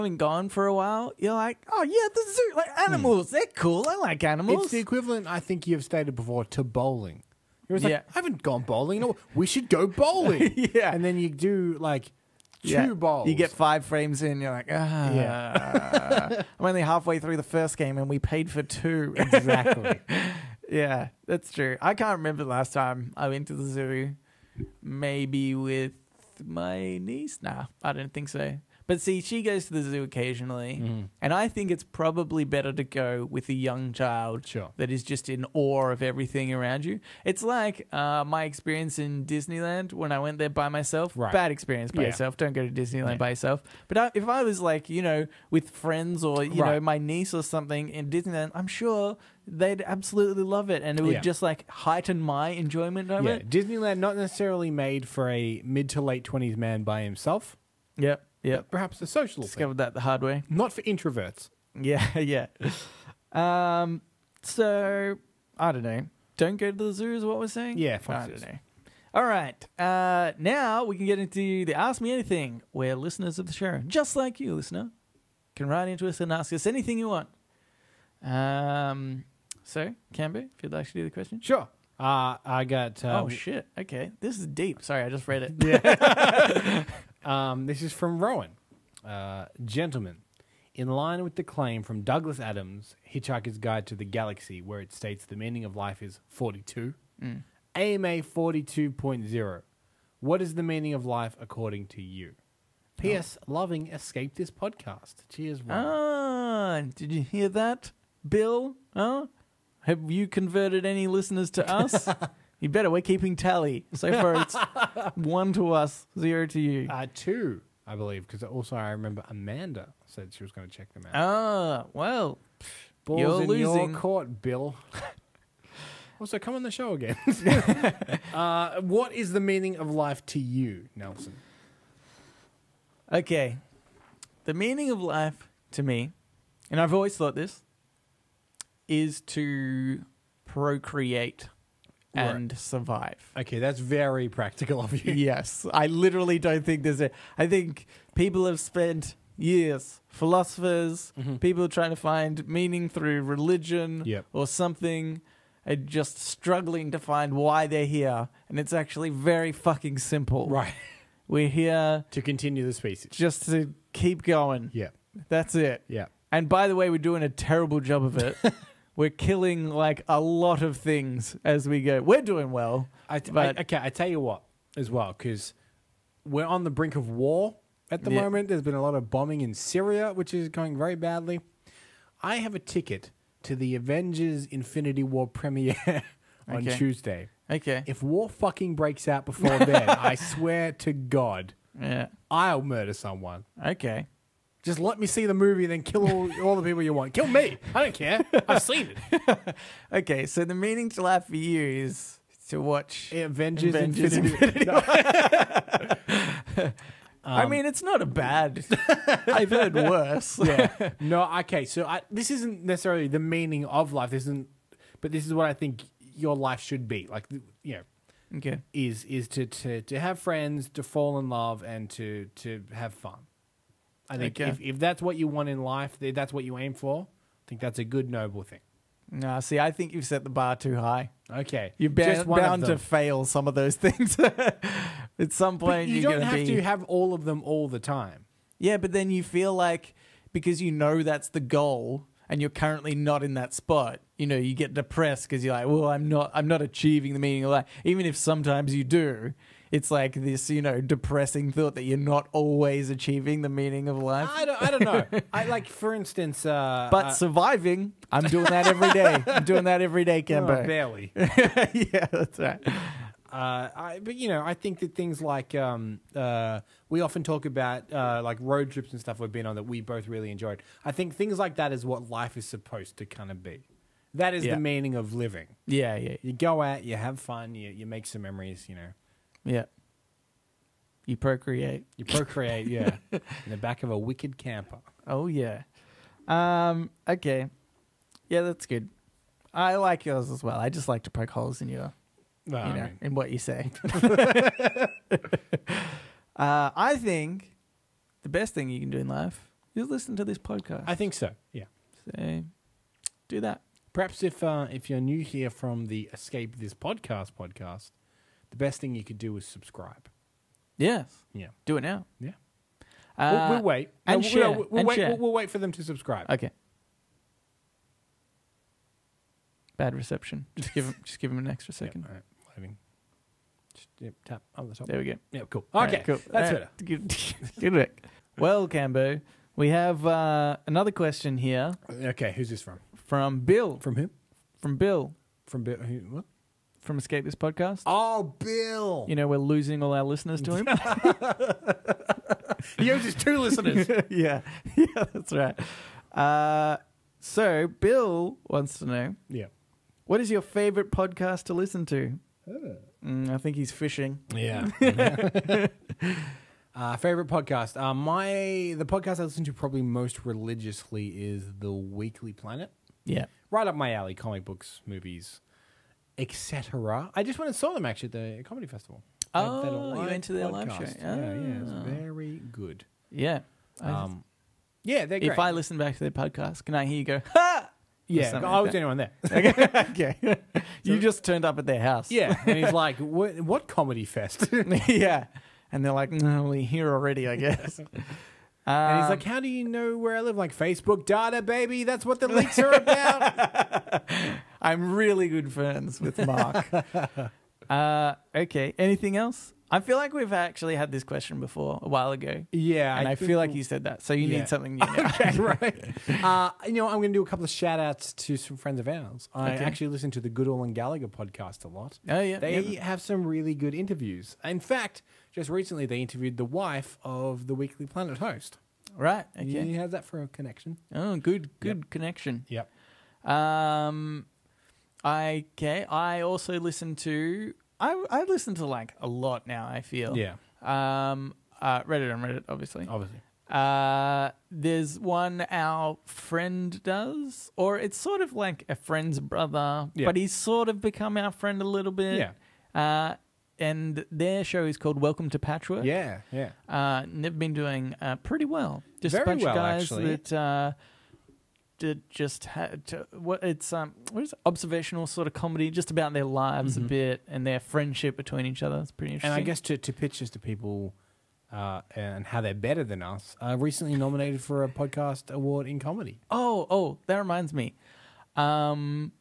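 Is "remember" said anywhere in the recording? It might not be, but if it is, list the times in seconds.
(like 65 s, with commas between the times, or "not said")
22 s, 118 s.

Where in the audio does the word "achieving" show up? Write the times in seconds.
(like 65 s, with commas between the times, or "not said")
246 s, 252 s.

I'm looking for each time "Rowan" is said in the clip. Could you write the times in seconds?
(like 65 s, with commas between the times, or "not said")
88 s, 105 s.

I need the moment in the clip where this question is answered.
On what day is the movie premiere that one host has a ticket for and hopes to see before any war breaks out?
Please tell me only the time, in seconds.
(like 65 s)
186 s.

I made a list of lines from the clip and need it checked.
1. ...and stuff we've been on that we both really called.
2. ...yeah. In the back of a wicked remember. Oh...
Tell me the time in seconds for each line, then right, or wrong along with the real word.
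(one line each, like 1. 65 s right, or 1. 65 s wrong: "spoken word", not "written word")
1. 268 s wrong: "enjoyed", not "called"
2. 282 s wrong: "camper", not "remember".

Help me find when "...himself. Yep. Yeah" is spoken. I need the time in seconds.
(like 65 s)
57 s.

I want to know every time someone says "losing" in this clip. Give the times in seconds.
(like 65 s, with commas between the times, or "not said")
123 s, 339 s.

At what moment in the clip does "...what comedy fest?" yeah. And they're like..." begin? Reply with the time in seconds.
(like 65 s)
383 s.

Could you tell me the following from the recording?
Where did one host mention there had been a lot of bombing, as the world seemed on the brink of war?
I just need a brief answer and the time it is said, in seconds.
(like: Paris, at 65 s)
Syria, at 179 s.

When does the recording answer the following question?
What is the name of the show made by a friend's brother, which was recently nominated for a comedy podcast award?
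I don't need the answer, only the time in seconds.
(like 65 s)
444 s.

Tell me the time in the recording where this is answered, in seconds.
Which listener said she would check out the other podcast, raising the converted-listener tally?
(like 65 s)
119 s.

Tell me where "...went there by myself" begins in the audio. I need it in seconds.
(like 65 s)
40 s.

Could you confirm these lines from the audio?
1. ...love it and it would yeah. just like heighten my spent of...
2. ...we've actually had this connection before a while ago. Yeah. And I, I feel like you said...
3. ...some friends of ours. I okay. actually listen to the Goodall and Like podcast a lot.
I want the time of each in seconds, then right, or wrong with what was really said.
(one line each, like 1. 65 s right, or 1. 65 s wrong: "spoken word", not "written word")
1. 50 s wrong: "enjoyment", not "spent"
2. 400 s wrong: "question", not "connection"
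3. 408 s wrong: "Gallagher", not "Like".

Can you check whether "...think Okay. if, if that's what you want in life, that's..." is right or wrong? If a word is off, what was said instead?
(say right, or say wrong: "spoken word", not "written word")
right.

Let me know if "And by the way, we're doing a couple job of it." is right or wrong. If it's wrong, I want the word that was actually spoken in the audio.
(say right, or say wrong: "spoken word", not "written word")
wrong: "terrible", not "couple".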